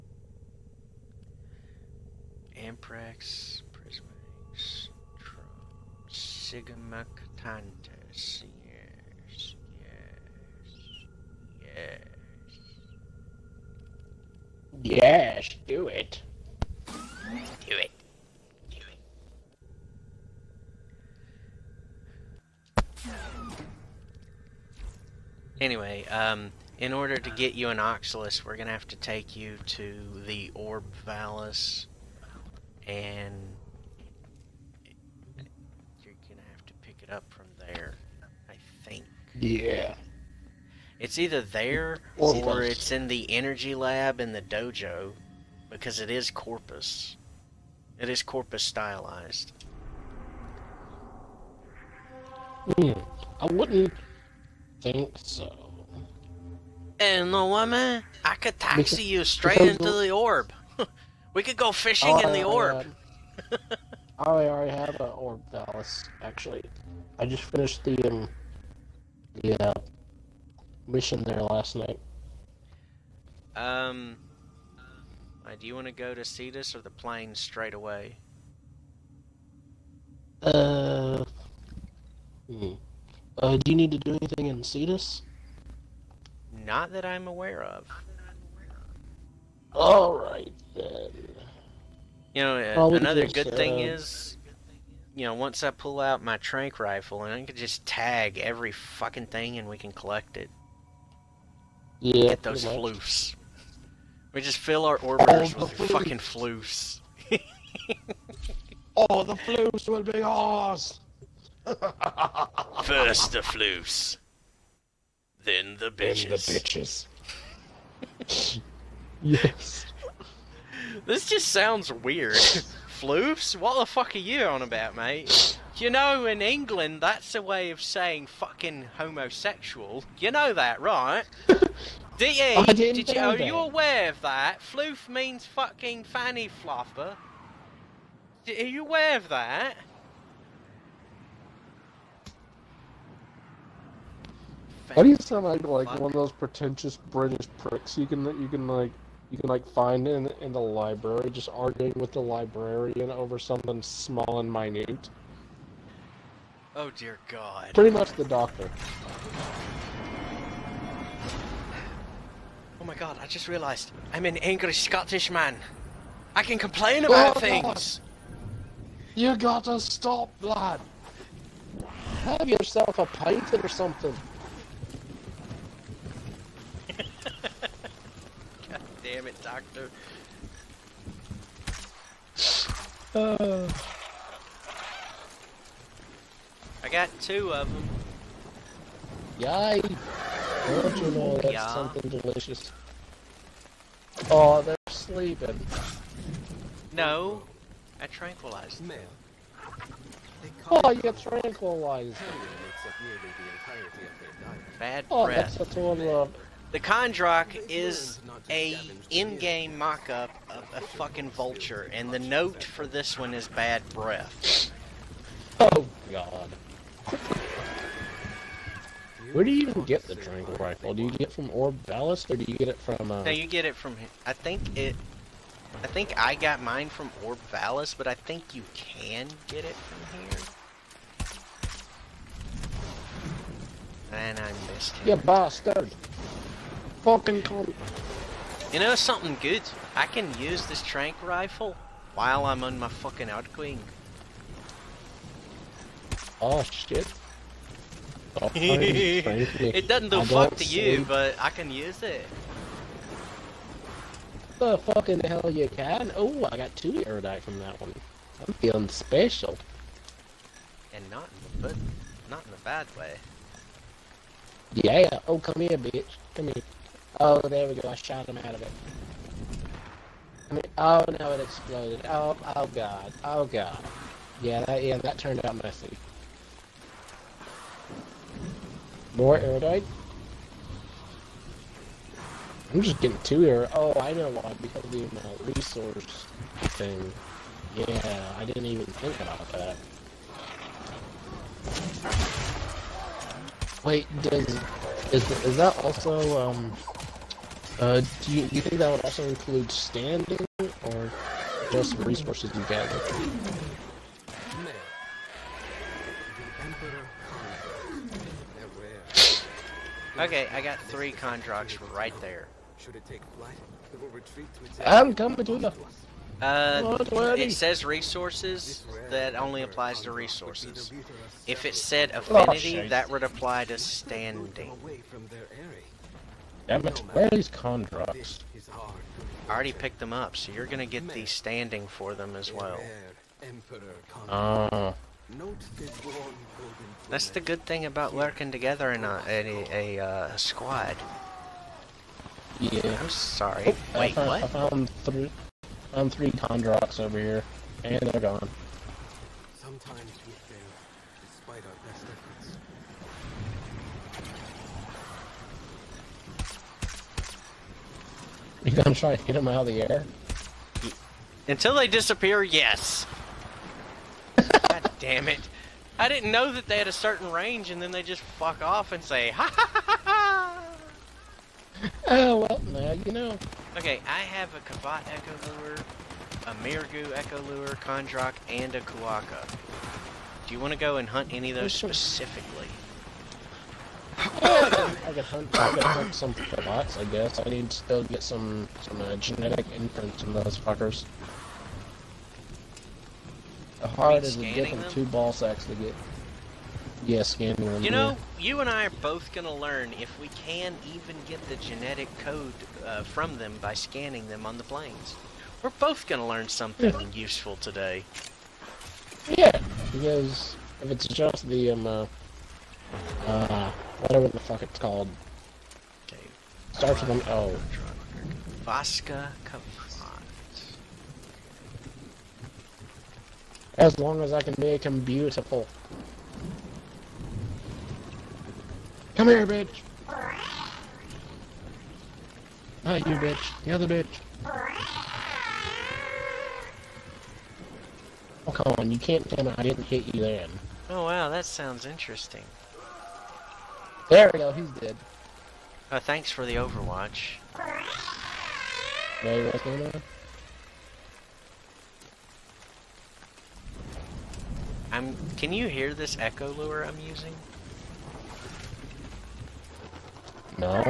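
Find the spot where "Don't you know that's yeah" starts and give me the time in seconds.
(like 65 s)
190 s.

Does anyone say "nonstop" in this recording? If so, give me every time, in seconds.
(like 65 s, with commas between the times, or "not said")
not said.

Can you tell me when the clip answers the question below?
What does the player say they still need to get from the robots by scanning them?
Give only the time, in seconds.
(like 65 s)
389 s.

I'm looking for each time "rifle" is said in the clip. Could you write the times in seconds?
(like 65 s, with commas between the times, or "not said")
96 s, 220 s, 241 s.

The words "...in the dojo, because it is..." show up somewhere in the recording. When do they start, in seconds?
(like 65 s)
44 s.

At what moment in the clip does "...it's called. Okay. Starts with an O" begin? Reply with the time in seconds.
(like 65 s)
414 s.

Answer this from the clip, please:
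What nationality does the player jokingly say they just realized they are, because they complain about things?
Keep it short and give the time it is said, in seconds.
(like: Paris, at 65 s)
Scottish, at 164 s.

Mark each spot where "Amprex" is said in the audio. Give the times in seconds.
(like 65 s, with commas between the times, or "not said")
2 s.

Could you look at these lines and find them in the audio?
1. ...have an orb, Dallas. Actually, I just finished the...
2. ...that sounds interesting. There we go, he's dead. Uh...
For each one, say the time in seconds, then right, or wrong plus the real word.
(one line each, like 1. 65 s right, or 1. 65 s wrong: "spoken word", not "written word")
1. 64 s right
2. 441 s right.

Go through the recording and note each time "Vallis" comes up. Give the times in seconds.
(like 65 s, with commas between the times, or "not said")
31 s, 221 s, 227 s.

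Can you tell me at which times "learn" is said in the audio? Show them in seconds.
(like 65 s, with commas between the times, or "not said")
399 s, 406 s.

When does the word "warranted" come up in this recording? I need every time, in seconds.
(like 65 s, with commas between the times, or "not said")
not said.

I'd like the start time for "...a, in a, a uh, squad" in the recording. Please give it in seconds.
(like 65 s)
339 s.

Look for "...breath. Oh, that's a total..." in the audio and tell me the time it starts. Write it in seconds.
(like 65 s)
205 s.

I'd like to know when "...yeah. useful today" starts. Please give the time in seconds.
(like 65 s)
406 s.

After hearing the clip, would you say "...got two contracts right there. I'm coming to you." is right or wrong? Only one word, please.
wrong.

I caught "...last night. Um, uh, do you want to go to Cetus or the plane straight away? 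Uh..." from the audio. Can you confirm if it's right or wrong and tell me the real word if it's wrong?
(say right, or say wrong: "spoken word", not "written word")
right.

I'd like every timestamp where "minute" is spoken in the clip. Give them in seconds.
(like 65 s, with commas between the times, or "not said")
154 s.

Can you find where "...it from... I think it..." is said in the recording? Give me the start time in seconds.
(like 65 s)
223 s.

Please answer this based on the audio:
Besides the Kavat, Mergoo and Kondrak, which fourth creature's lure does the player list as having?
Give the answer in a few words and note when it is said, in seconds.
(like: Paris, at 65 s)
Kuaka, at 378 s.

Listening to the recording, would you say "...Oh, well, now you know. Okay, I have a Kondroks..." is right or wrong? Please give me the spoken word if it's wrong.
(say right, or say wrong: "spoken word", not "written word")
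wrong: "Kavat", not "Kondroks".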